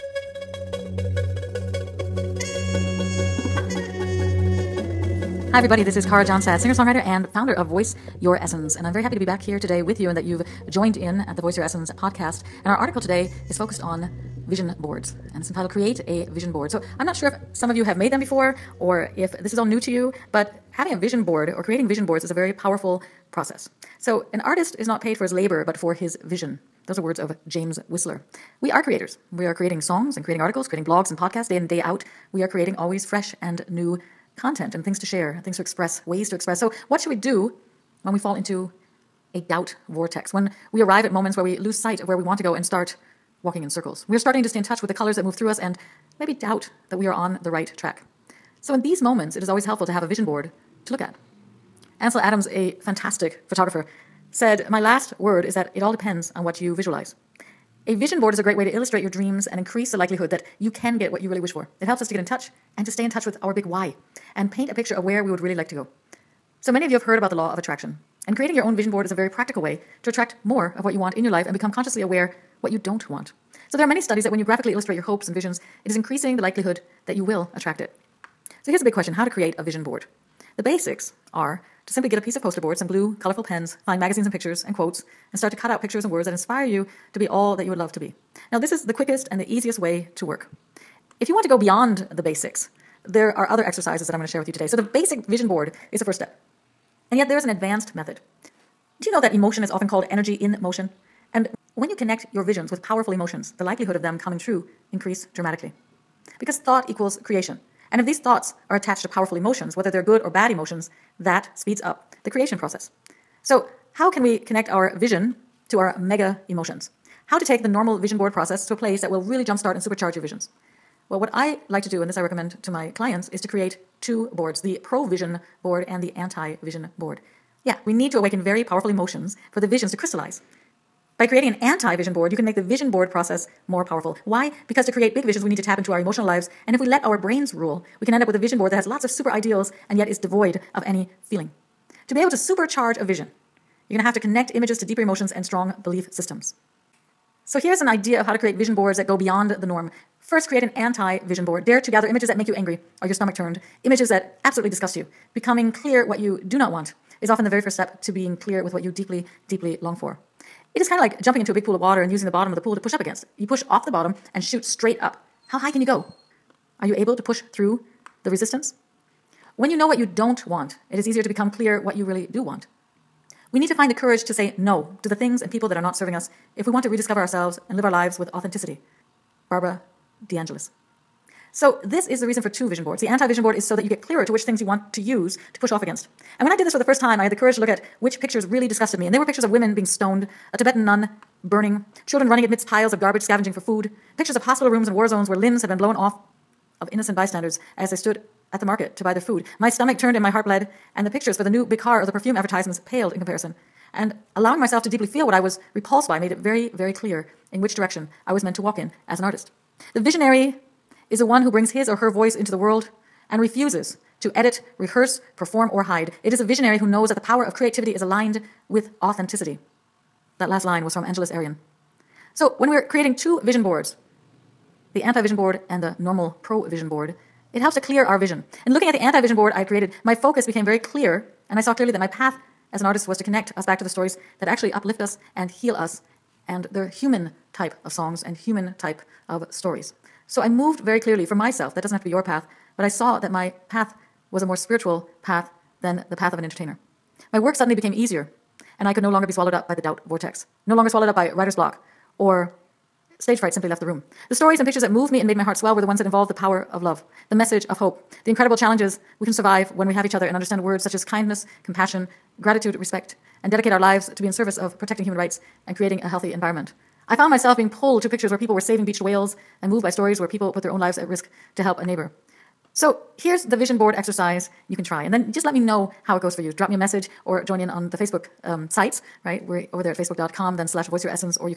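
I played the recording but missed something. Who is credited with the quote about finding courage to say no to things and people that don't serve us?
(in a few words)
Barbara DeAngelis.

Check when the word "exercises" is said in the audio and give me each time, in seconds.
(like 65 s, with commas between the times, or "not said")
93 s, 273 s.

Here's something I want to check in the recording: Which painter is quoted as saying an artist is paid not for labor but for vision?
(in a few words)
James Whistler.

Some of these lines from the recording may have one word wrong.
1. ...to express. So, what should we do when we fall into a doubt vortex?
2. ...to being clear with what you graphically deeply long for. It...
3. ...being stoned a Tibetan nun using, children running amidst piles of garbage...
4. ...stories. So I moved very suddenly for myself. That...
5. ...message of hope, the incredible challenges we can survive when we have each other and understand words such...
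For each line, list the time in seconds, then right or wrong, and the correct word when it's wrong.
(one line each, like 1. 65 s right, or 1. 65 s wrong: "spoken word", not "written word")
1. 36 s right
2. 158 s wrong: "deeply", not "graphically"
3. 189 s wrong: "burning", not "using"
4. 239 s wrong: "clearly", not "suddenly"
5. 257 s right.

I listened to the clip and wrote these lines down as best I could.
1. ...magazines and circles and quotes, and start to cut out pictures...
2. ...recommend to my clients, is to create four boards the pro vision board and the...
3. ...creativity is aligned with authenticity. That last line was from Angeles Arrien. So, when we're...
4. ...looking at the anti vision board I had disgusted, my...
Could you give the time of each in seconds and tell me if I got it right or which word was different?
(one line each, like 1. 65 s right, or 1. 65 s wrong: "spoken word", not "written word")
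1. 84 s wrong: "pictures", not "circles"
2. 122 s wrong: "two", not "four"
3. 217 s right
4. 228 s wrong: "created", not "disgusted".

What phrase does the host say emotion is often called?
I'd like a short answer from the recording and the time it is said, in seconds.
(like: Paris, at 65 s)
energy in motion, at 100 s.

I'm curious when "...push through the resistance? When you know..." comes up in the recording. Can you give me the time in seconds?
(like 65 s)
167 s.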